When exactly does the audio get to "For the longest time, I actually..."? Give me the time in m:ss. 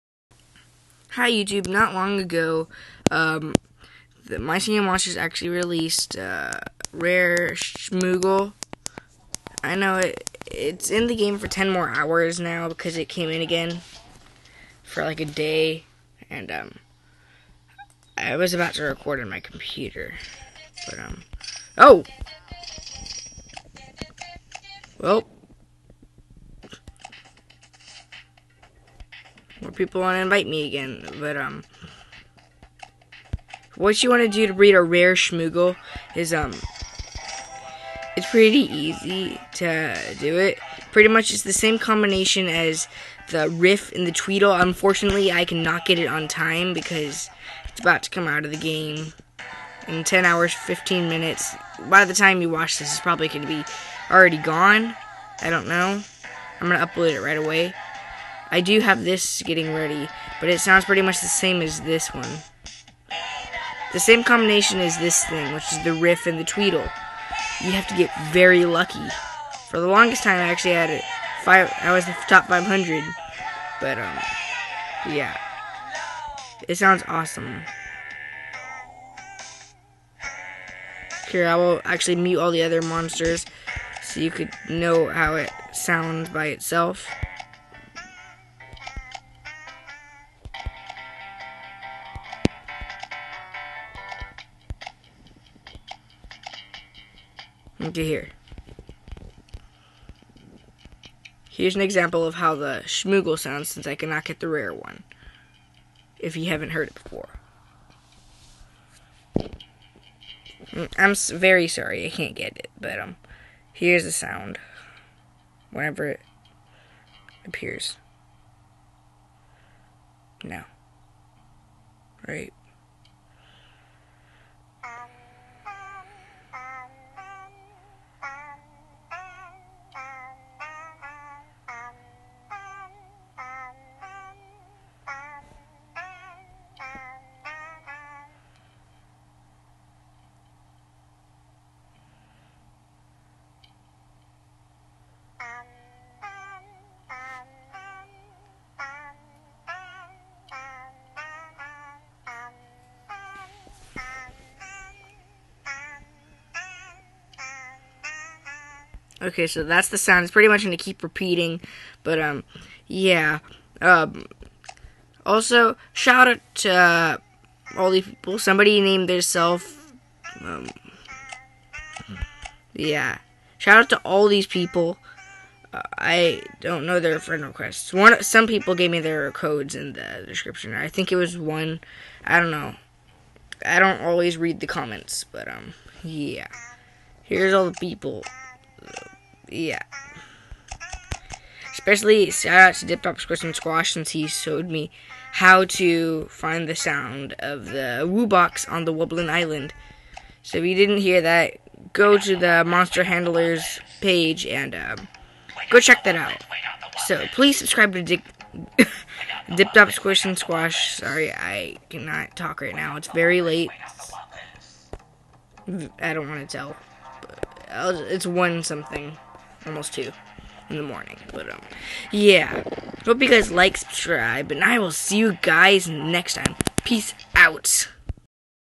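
1:09.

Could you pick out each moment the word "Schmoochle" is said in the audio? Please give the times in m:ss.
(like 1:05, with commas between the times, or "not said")
0:07, 0:35, 1:42.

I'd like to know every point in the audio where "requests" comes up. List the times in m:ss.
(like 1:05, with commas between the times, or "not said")
2:57.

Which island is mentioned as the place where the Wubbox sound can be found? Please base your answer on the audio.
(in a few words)
Wublin Island.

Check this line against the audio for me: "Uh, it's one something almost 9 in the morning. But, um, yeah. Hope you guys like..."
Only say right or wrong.
wrong.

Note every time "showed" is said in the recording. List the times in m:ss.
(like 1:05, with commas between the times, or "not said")
3:14.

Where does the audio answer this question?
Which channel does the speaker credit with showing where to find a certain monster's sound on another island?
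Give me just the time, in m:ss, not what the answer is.
3:12.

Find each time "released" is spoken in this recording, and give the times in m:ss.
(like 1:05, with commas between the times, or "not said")
0:05.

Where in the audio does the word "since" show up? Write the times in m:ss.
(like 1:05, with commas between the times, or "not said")
1:43, 3:13.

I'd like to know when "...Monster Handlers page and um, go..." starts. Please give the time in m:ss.
3:22.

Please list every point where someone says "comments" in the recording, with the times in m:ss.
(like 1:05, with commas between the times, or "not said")
3:04.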